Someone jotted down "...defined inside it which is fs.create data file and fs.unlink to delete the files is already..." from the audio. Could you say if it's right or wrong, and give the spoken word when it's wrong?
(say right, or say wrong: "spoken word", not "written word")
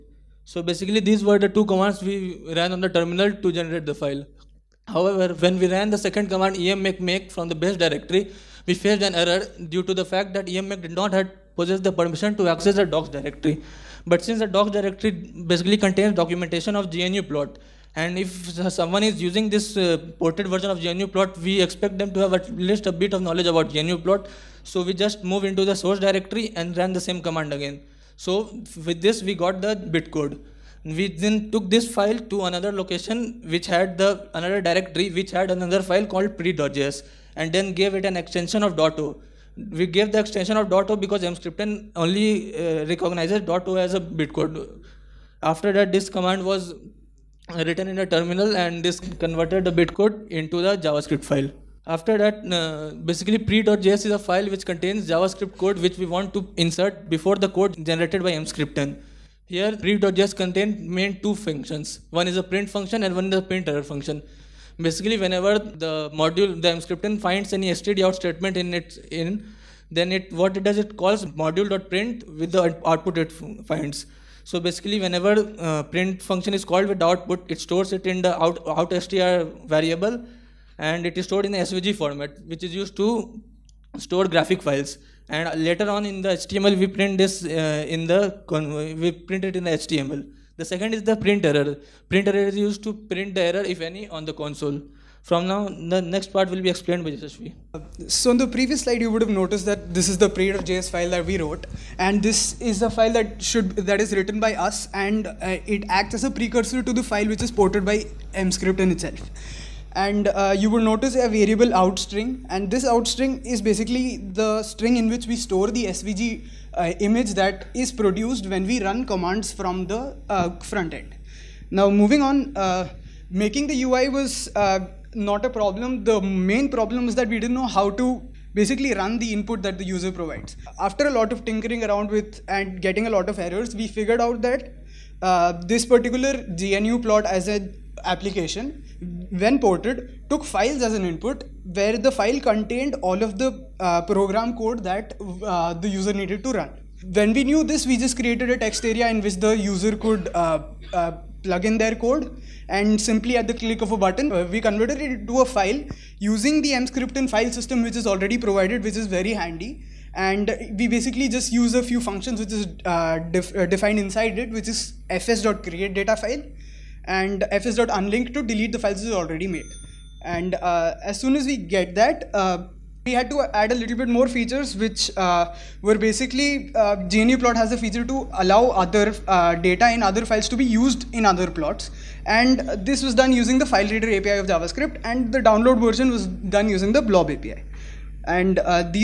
right.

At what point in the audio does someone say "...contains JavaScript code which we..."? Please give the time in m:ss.
0:54.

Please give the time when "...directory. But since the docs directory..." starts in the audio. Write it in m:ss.
0:13.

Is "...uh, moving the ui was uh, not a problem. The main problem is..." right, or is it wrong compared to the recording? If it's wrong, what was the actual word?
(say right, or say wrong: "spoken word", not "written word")
wrong: "making", not "moving".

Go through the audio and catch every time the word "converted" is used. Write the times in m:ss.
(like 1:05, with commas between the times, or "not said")
0:48, 2:34.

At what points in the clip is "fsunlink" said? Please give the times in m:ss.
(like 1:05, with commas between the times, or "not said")
2:47.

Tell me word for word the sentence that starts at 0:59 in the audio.
Here pre.js contains main two functions.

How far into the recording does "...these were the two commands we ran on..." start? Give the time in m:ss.
0:00.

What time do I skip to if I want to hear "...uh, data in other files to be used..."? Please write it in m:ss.
2:59.